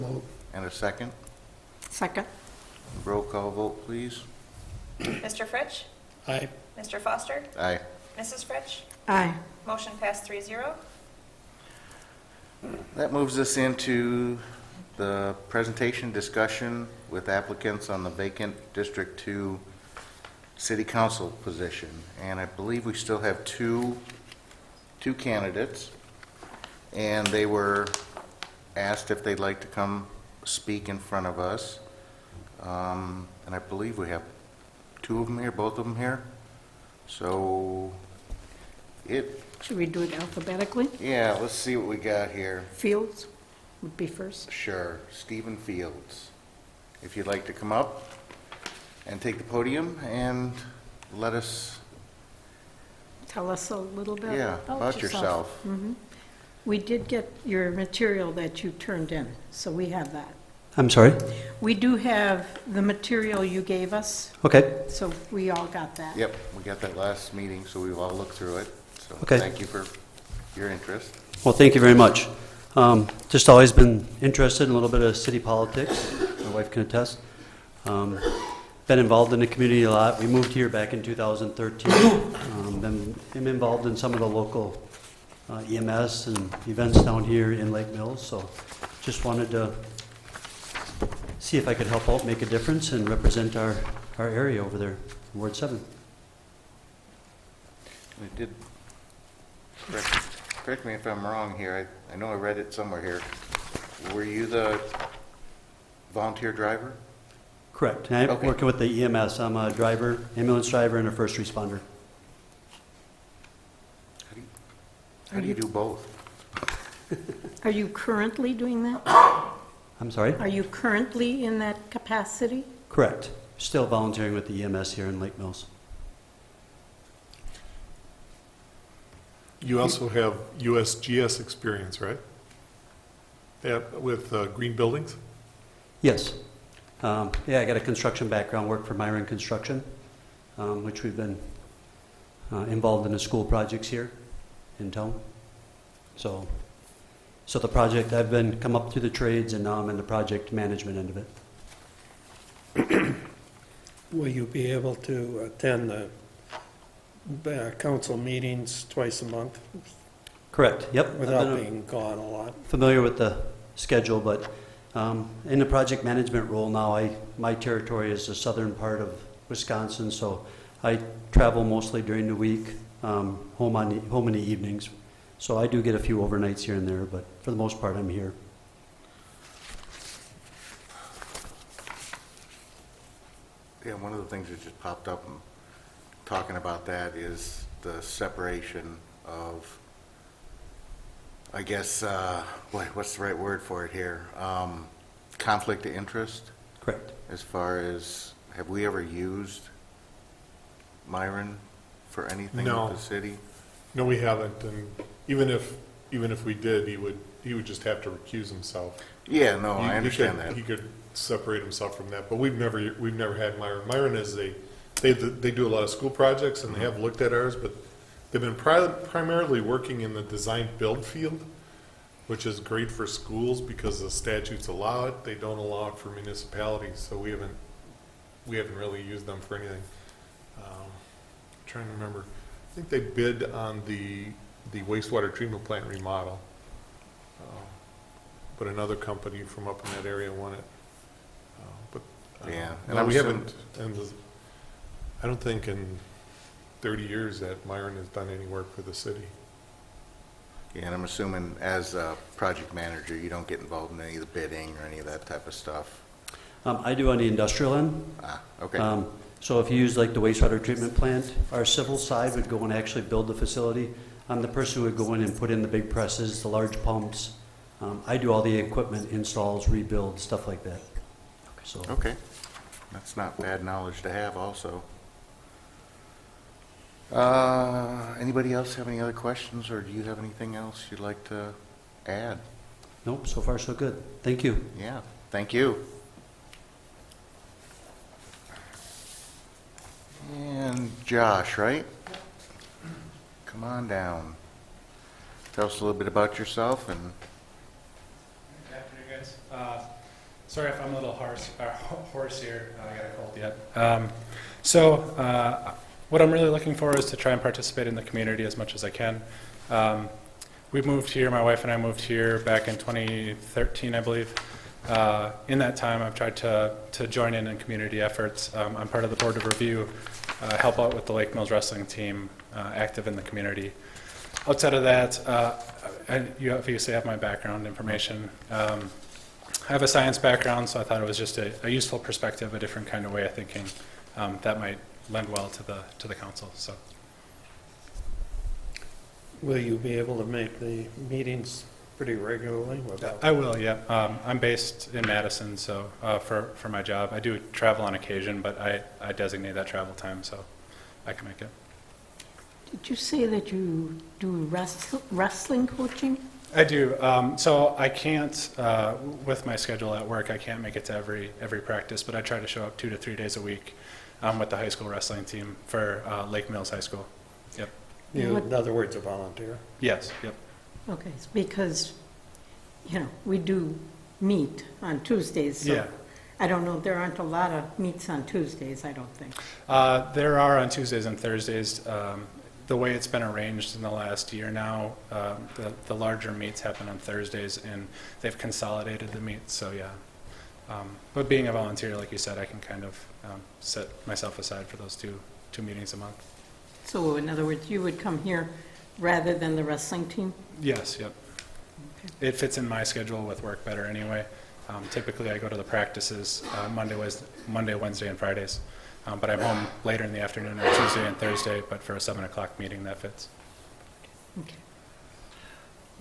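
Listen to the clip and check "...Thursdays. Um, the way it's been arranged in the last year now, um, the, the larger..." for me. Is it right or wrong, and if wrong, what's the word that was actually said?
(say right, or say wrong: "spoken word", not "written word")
right.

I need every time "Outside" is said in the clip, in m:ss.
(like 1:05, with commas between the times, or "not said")
5:24.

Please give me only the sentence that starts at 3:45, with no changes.
They don't allow it for municipalities, so we haven't, we haven't really used them for anything.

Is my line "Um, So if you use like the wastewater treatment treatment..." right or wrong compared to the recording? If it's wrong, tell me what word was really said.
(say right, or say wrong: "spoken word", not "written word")
wrong: "plant", not "treatment".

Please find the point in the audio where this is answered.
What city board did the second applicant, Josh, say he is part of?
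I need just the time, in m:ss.
5:19.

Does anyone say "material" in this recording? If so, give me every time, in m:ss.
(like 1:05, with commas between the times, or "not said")
0:57, 1:02.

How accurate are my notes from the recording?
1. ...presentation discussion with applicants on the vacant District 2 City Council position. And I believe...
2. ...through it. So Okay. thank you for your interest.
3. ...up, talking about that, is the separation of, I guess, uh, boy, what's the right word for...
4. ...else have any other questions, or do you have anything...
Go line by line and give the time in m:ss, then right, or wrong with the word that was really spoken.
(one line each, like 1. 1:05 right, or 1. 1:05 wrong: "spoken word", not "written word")
1. 0:15 right
2. 1:08 right
3. 3:05 right
4. 4:38 right.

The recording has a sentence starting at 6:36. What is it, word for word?
So in other words, you would come here rather than the wrestling team?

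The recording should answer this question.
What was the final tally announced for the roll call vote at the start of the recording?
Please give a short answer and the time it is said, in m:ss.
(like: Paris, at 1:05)
3-0, at 0:10.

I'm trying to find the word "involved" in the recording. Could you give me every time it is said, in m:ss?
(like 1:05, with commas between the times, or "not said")
1:18, 1:23, 2:22, 4:13.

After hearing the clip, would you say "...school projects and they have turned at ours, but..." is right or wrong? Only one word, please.
wrong.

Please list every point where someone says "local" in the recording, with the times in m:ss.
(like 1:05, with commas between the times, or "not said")
1:24.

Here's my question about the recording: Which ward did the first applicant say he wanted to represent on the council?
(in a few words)
Ward 7.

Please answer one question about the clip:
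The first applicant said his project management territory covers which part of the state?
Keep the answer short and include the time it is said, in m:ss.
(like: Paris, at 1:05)
southern part of Wisconsin, at 2:48.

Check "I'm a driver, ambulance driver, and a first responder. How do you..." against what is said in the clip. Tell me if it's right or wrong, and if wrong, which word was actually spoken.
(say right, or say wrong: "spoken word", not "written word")
right.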